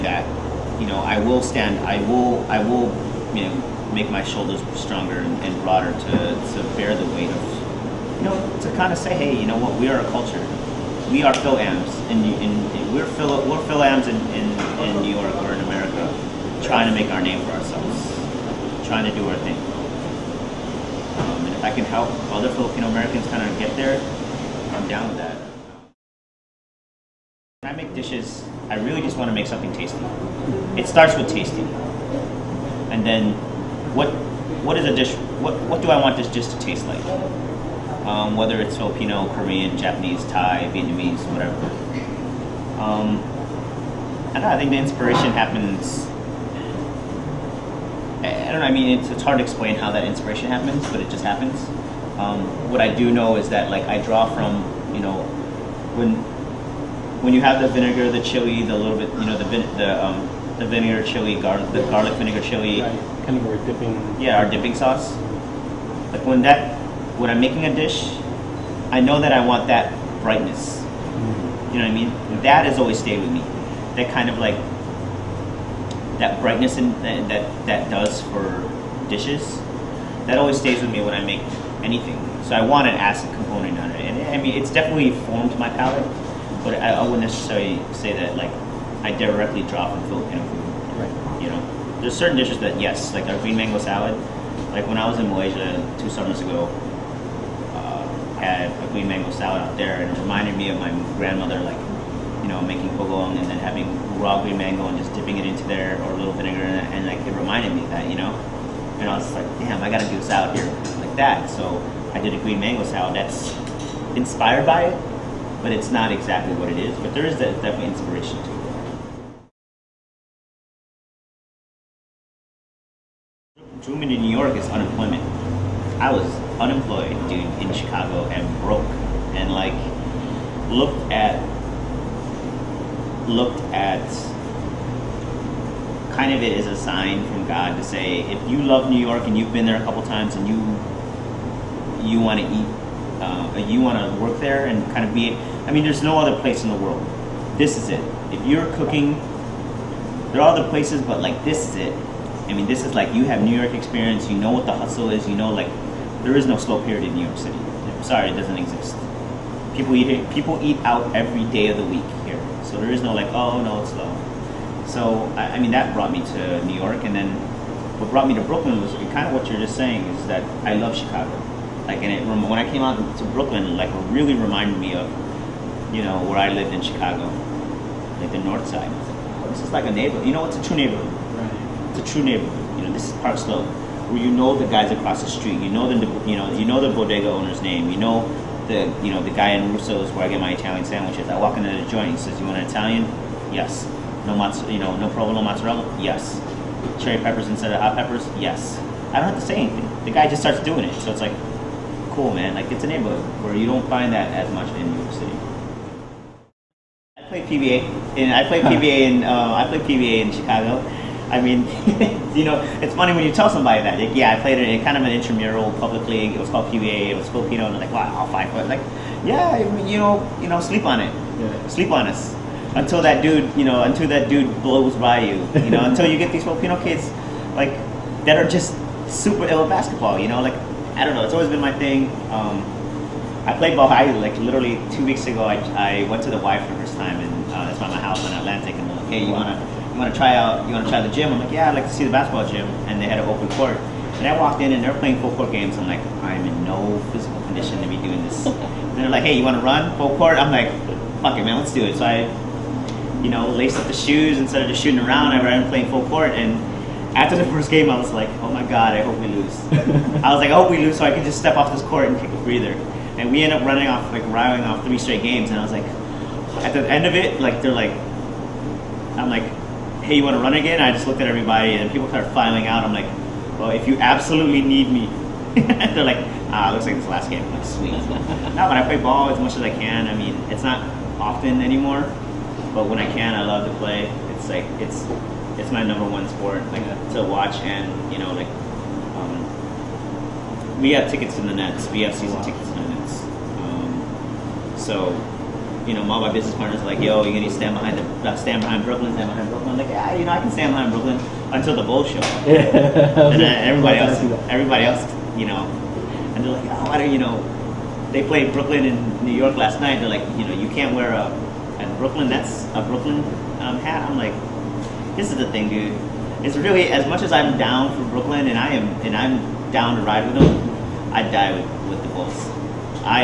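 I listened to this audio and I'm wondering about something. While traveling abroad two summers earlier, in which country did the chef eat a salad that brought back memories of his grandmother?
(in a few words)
Malaysia.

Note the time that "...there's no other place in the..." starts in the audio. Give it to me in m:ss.
2:25.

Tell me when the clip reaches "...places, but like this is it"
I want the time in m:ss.
2:30.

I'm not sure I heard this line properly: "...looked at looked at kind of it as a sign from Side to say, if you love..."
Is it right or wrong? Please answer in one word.
wrong.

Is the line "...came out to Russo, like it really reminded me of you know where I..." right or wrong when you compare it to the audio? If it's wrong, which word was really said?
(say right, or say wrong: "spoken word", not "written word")
wrong: "Brooklyn", not "Russo".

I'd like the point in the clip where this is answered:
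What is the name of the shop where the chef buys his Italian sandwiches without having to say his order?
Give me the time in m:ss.
3:09.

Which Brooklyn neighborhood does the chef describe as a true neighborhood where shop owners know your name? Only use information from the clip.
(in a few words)
Park Slope.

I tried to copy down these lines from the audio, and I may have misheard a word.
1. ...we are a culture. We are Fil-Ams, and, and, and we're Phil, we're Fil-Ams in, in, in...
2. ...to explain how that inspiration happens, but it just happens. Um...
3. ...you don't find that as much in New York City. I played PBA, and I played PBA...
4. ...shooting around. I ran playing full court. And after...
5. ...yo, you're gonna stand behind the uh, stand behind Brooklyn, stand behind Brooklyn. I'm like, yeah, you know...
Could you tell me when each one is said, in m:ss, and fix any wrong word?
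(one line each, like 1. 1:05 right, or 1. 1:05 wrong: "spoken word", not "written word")
1. 0:09 right
2. 0:49 right
3. 3:23 right
4. 4:14 right
5. 4:56 right.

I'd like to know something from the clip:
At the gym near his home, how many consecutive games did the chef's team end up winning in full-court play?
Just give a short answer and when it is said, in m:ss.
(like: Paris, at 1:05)
3, at 4:24.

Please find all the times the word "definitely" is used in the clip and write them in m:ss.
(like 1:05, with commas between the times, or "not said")
1:24, 1:57.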